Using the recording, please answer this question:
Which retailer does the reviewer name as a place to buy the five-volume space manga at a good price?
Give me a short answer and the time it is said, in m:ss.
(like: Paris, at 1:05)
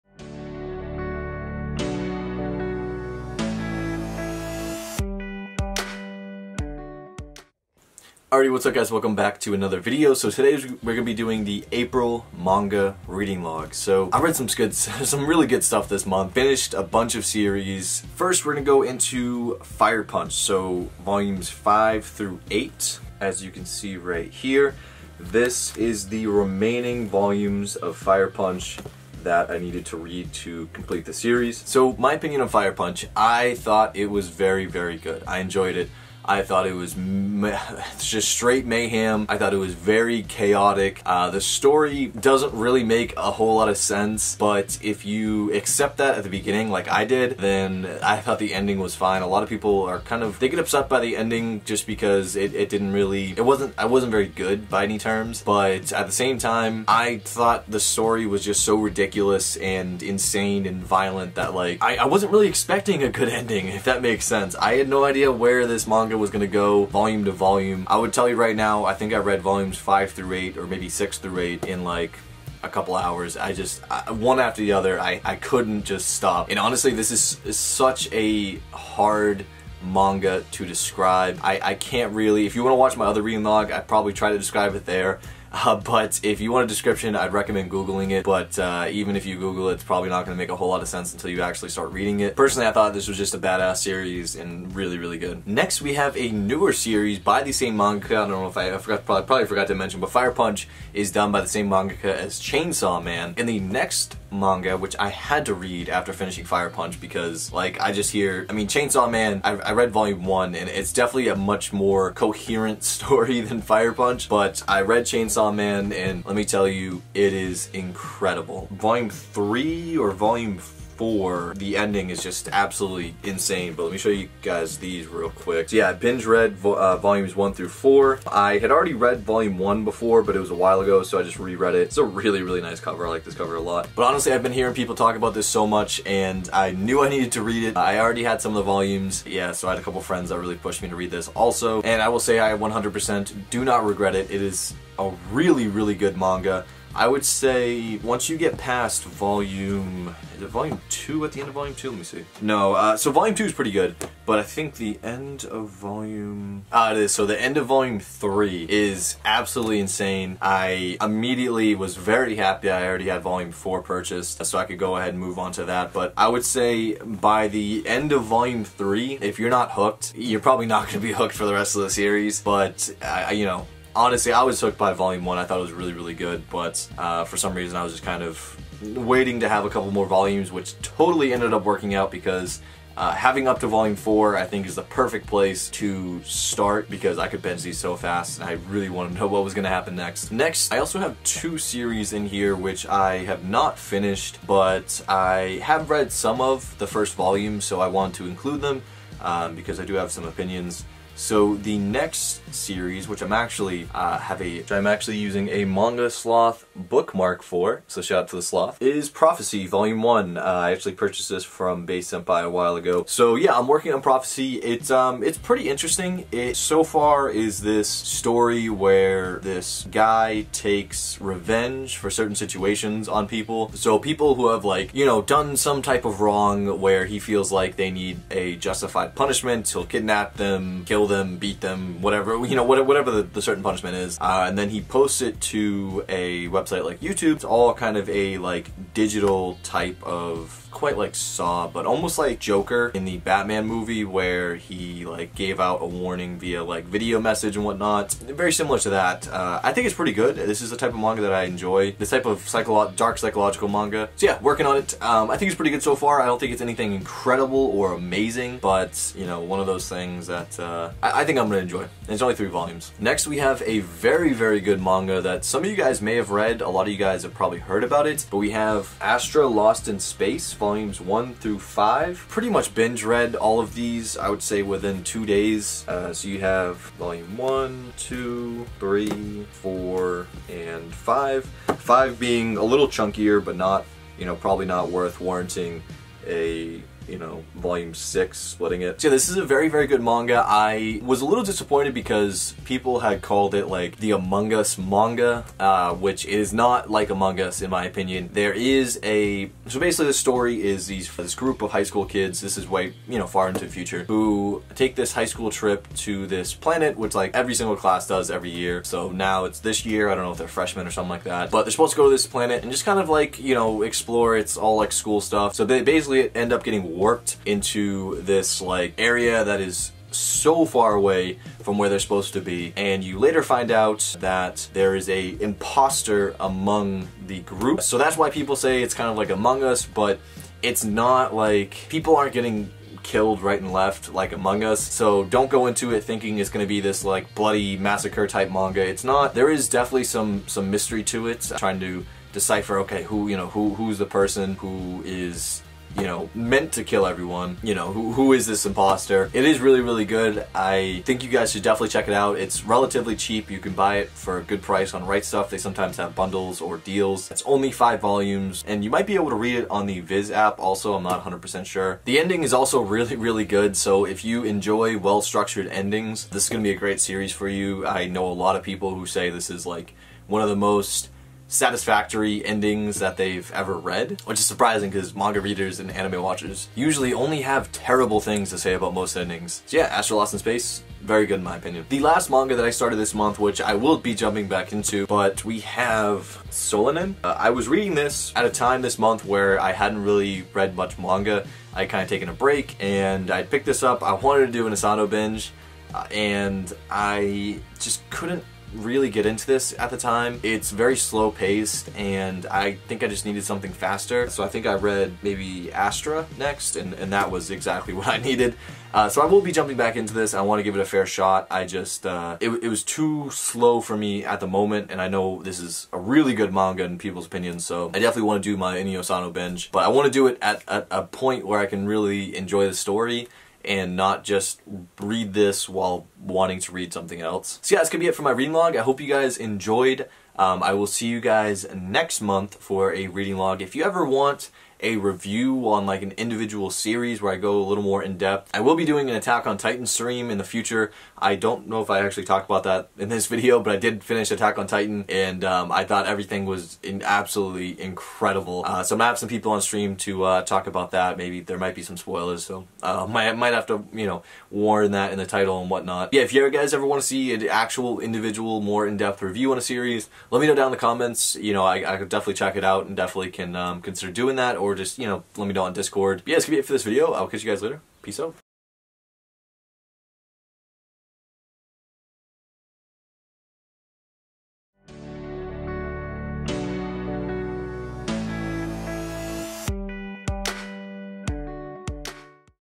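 Right Stuf, at 5:55.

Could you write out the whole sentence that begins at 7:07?
So yeah, that's gonna be it for my reading log.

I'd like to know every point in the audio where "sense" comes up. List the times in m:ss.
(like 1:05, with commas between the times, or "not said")
0:43, 1:04, 1:30.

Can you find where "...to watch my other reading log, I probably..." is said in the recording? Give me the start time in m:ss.
1:22.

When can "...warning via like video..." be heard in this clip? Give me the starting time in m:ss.
4:05.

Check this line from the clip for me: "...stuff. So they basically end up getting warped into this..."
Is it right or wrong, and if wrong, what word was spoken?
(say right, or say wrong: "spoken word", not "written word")
right.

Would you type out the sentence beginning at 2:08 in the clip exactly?
I had already read volume 1 before, but it was a while ago, so I just reread it.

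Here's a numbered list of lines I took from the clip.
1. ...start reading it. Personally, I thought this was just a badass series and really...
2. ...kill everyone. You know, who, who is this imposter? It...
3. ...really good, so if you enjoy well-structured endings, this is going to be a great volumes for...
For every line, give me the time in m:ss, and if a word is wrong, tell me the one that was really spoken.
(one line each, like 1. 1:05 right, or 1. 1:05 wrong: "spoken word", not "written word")
1. 1:31 right
2. 5:46 right
3. 6:03 wrong: "series", not "volumes".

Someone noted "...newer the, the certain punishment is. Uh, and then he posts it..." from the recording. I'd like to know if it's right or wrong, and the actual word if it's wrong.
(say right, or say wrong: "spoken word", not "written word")
wrong: "whatever", not "newer".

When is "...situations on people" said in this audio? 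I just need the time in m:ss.
3:42.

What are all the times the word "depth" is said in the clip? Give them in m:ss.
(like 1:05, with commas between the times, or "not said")
7:18, 7:38.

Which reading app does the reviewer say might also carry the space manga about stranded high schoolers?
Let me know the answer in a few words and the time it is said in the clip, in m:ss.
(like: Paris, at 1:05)
Viz, at 5:59.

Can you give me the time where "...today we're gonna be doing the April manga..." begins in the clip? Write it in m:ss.
0:10.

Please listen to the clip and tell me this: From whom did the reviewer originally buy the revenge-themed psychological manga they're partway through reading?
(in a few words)
Base Senpai.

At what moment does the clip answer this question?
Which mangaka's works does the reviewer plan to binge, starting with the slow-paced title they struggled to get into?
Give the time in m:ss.
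6:58.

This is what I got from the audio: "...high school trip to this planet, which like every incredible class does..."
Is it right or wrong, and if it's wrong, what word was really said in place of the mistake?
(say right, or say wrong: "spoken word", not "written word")
wrong: "single", not "incredible".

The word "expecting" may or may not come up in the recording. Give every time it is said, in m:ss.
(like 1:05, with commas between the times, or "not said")
1:02.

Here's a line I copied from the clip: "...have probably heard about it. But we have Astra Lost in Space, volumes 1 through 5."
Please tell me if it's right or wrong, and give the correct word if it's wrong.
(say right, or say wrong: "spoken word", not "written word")
right.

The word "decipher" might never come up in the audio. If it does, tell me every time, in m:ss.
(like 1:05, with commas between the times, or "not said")
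5:42.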